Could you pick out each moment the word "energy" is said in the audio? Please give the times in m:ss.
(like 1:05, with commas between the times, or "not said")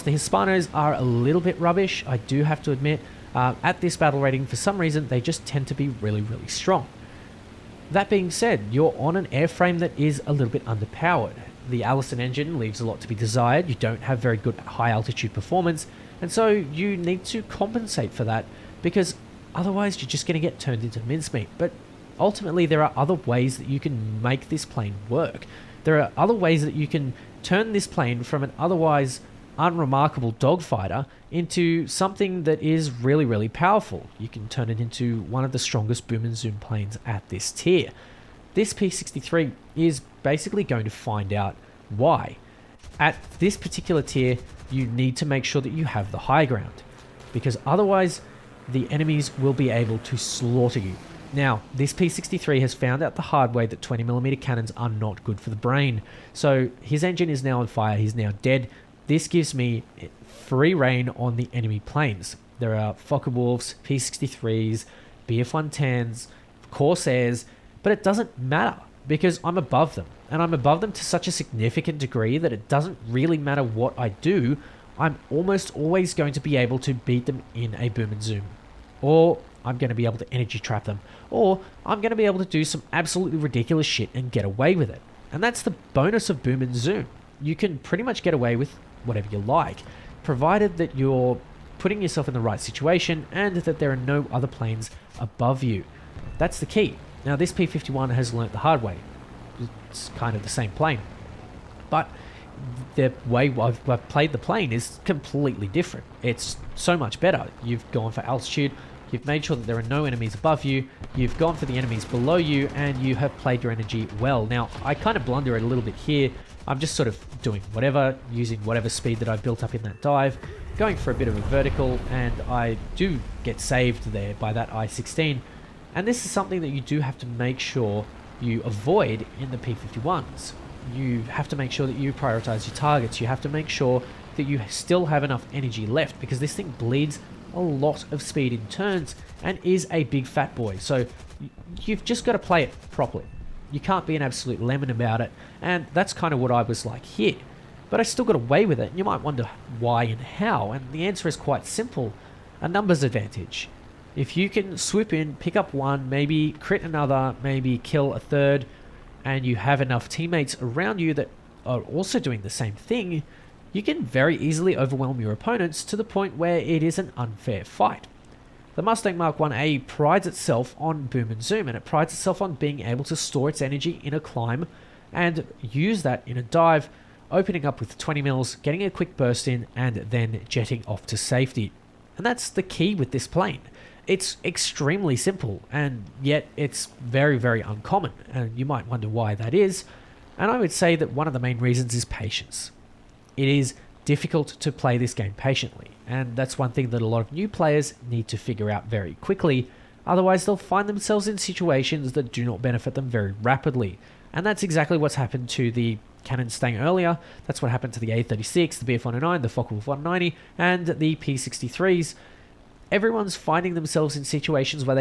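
1:20, 1:53, 2:15, 2:53.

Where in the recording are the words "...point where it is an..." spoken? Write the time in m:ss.
2:46.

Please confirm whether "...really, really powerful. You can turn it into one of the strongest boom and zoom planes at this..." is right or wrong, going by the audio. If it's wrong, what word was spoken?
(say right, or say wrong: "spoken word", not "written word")
right.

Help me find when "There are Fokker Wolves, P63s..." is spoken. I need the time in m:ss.
1:02.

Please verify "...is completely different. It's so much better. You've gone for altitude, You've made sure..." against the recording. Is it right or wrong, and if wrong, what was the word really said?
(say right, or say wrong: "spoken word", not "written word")
right.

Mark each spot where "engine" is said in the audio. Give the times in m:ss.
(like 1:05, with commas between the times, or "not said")
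0:12, 0:57.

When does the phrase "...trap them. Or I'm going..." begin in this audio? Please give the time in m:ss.
1:20.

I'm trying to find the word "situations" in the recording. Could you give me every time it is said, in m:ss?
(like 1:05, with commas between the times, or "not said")
1:32, 3:21, 3:34.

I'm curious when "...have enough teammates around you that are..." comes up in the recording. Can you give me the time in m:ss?
2:39.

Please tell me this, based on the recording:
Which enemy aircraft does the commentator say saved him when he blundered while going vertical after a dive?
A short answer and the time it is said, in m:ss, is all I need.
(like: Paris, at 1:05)
I-16, at 2:04.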